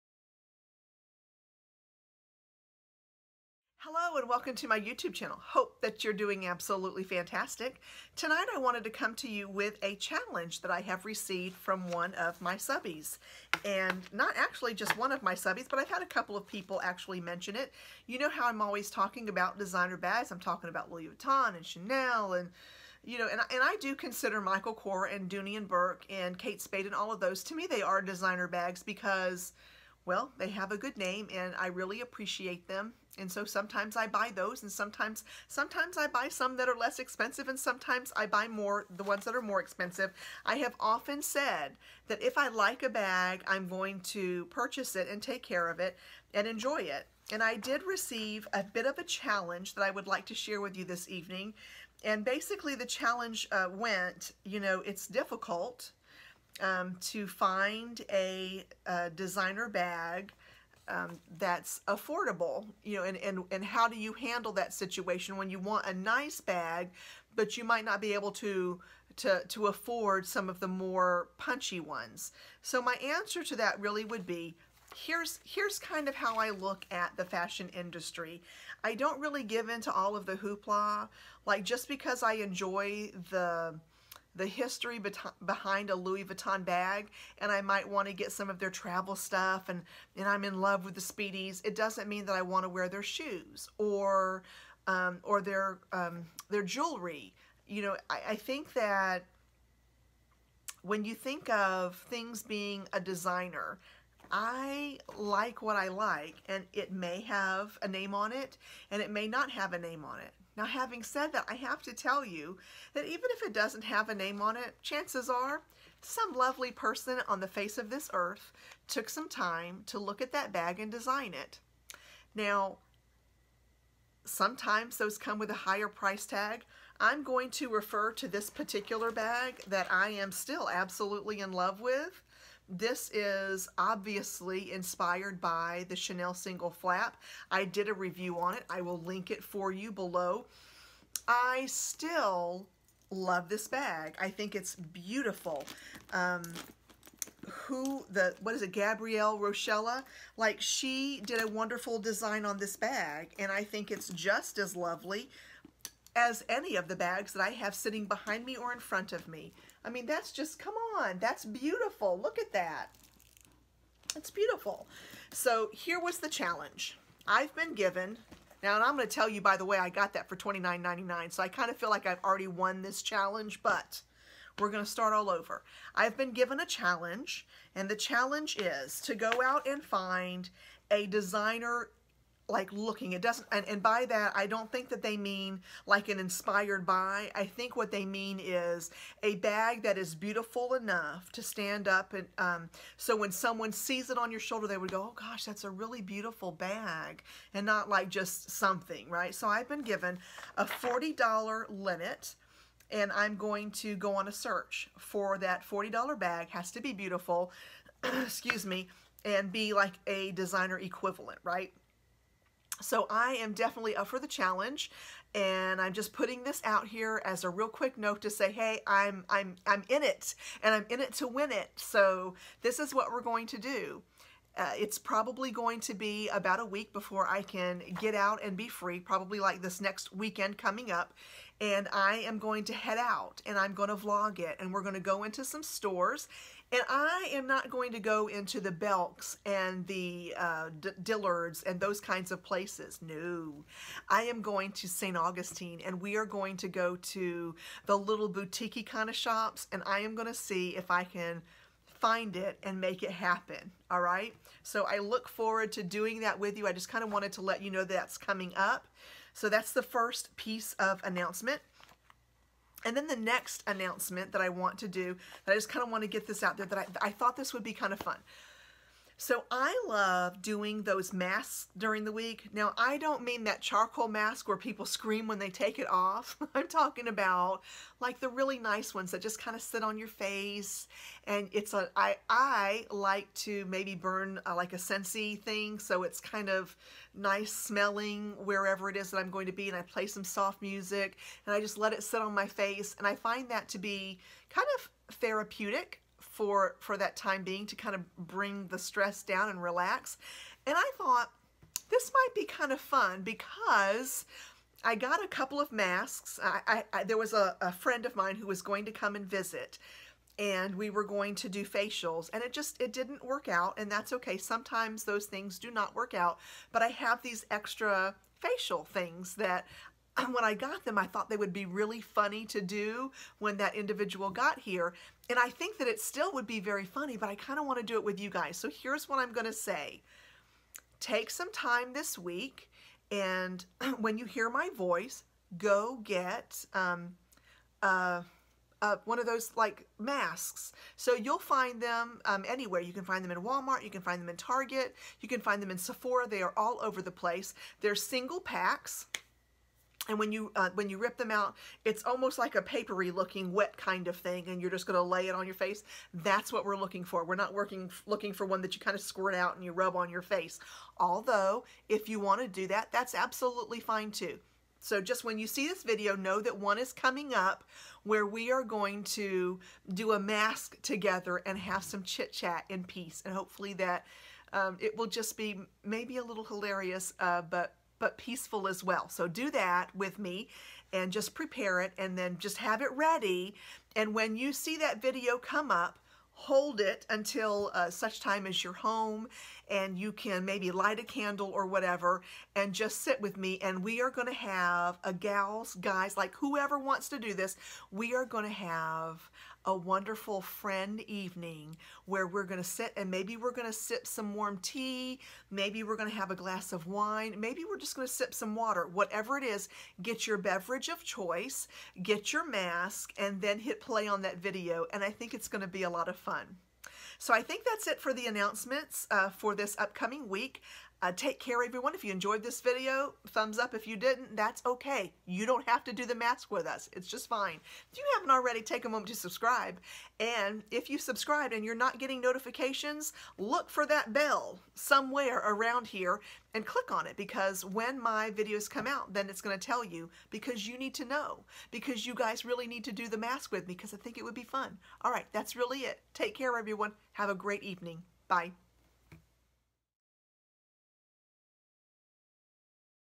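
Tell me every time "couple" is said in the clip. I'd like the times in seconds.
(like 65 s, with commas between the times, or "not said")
16 s, 305 s.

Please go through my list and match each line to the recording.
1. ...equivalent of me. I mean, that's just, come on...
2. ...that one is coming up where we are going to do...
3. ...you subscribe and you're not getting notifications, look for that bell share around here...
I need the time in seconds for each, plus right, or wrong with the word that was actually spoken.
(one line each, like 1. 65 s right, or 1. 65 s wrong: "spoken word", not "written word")
1. 158 s wrong: "front", not "equivalent"
2. 366 s right
3. 430 s wrong: "somewhere", not "share".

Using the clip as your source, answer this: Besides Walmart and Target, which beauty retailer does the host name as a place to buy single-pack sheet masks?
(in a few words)
Sephora.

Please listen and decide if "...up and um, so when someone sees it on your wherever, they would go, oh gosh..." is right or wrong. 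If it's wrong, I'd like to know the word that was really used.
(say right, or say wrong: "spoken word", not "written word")
wrong: "shoulder", not "wherever".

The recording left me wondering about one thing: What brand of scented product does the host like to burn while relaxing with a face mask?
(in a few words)
Scentsy.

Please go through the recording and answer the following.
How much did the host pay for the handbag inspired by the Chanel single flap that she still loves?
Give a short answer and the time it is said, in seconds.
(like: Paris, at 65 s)
$29.99, at 170 s.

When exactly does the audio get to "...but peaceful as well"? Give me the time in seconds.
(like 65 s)
378 s.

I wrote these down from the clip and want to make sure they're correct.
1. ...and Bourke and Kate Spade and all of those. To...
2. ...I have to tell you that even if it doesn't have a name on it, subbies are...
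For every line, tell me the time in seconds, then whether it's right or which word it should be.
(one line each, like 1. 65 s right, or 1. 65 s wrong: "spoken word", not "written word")
1. 25 s right
2. 111 s wrong: "chances", not "subbies".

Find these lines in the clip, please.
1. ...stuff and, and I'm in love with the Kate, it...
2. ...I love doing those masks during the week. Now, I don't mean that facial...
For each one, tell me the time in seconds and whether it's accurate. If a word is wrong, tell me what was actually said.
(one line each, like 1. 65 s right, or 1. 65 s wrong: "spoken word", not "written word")
1. 89 s wrong: "Speedies", not "Kate"
2. 269 s wrong: "charcoal", not "facial".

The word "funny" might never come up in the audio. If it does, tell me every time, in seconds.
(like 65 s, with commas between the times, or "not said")
322 s, 326 s.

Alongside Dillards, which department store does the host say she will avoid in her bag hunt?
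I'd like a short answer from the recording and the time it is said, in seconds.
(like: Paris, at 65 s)
Belks, at 238 s.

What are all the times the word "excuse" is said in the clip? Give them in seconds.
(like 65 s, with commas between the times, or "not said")
208 s.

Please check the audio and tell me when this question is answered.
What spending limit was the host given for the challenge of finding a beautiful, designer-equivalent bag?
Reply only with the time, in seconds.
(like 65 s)
200 s.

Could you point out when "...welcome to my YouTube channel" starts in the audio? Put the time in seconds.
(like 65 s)
4 s.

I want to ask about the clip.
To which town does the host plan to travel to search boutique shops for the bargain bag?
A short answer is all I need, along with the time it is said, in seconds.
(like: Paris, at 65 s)
St. Augustine, at 244 s.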